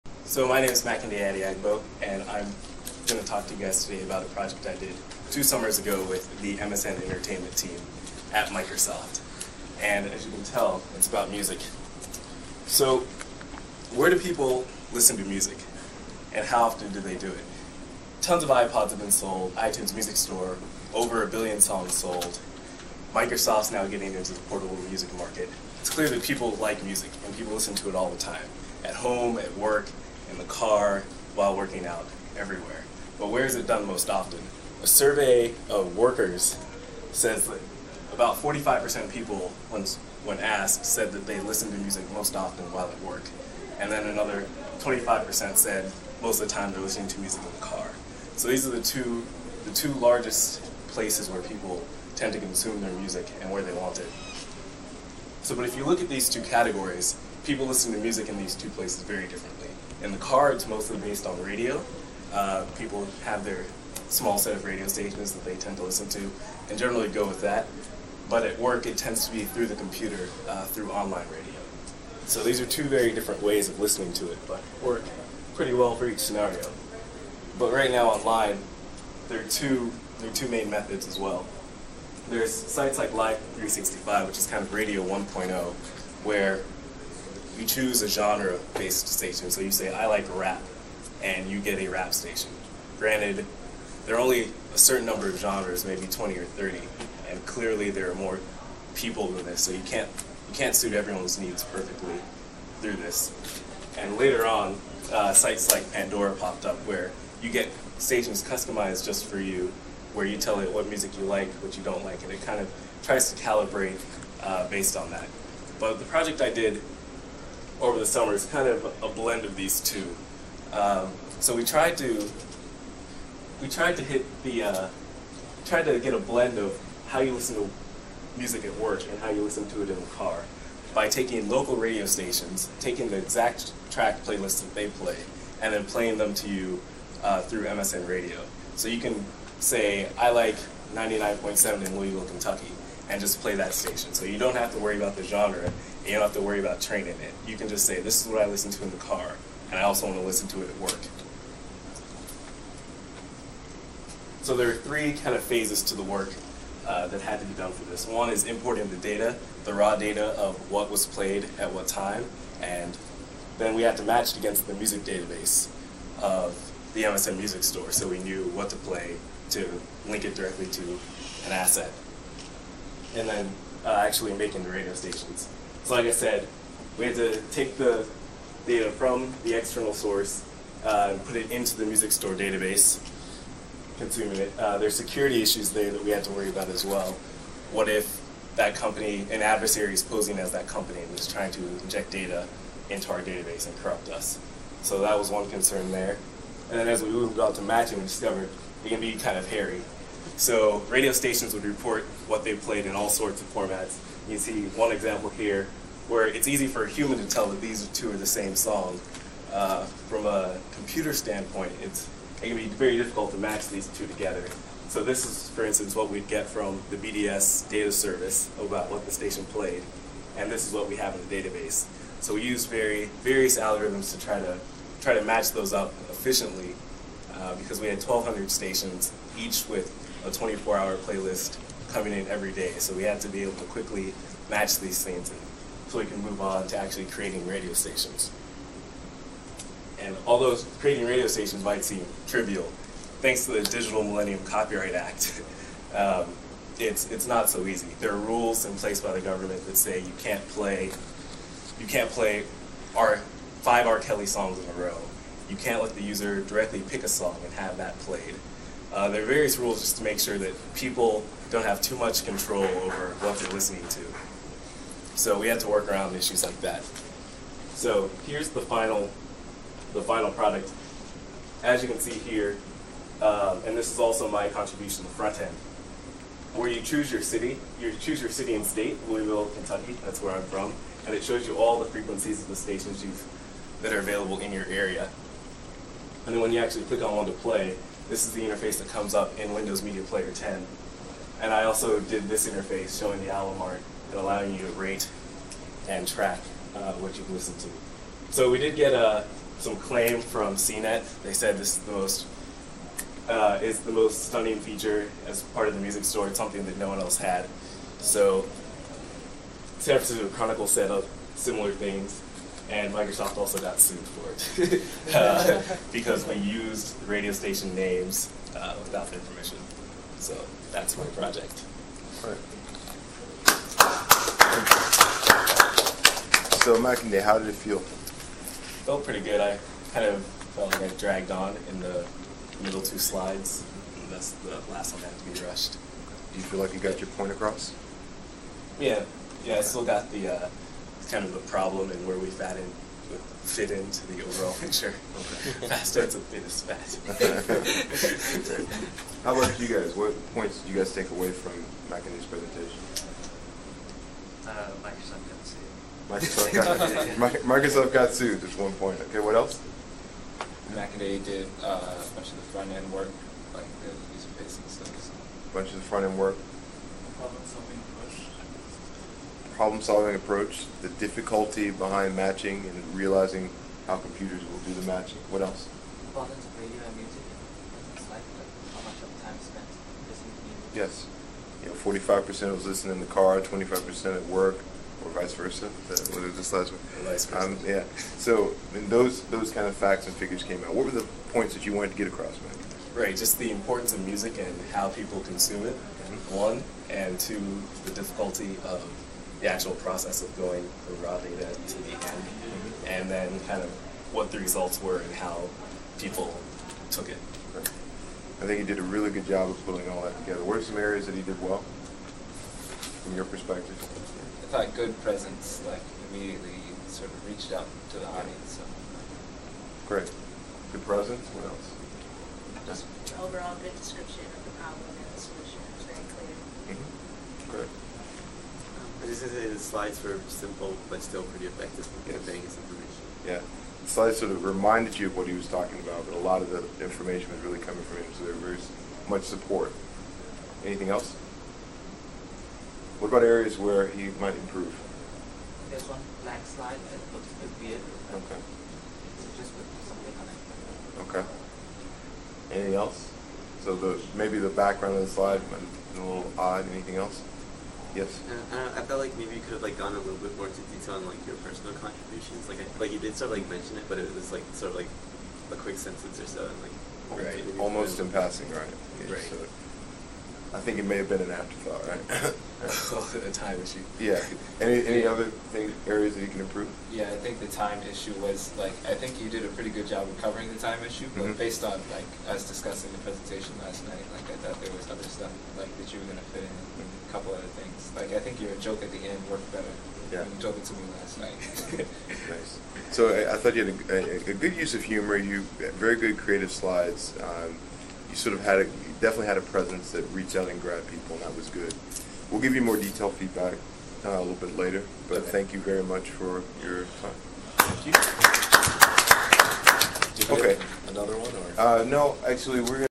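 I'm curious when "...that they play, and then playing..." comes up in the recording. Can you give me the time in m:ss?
2:14.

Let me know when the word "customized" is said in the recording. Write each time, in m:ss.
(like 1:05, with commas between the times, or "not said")
1:48.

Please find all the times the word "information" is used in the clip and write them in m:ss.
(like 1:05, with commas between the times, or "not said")
7:12, 7:16.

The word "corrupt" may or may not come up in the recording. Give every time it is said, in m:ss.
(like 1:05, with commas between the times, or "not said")
3:13.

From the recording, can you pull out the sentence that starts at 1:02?
Uh, people have their small set of radio stations that they tend to listen to and generally go with that.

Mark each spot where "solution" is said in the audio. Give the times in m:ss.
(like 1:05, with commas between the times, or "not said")
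7:05.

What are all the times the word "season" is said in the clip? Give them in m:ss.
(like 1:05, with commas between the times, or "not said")
not said.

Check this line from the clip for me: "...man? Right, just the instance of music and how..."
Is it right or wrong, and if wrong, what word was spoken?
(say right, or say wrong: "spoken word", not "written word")
wrong: "importance", not "instance".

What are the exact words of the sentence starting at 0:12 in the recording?
So where do people listen to music, and how often do they do it?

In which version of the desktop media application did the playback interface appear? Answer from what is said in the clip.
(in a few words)
Windows Media Player 10.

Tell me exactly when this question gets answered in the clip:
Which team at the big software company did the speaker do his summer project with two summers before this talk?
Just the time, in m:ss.
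0:06.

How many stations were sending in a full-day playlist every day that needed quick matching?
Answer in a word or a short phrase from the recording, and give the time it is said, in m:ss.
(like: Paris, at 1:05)
1,200, at 3:48.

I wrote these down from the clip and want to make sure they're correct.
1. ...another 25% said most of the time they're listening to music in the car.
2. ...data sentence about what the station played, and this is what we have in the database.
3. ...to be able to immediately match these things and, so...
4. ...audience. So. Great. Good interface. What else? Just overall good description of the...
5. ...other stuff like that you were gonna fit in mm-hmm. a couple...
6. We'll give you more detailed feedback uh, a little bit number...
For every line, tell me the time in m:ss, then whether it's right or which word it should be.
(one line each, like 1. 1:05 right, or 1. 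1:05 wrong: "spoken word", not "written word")
1. 0:44 right
2. 3:37 wrong: "service", not "sentence"
3. 3:53 wrong: "quickly", not "immediately"
4. 6:58 wrong: "presence", not "interface"
5. 8:04 right
6. 8:22 wrong: "later", not "number".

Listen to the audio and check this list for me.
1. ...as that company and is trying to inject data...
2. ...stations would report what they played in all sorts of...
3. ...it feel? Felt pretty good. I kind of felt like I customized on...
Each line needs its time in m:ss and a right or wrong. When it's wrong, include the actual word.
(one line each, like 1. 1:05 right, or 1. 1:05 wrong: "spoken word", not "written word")
1. 3:10 right
2. 3:21 right
3. 5:27 wrong: "dragged", not "customized".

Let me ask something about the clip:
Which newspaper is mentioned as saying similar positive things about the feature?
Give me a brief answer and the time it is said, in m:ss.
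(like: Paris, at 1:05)
San Francisco Chronicle, at 5:09.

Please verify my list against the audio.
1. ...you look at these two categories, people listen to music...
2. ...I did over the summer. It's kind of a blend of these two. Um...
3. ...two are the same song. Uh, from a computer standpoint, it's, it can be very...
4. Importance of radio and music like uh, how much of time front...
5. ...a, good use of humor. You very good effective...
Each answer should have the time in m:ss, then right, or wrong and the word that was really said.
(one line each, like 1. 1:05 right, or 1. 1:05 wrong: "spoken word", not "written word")
1. 0:55 right
2. 1:56 right
3. 3:27 right
4. 6:16 wrong: "spent", not "front"
5. 8:14 wrong: "creative", not "effective".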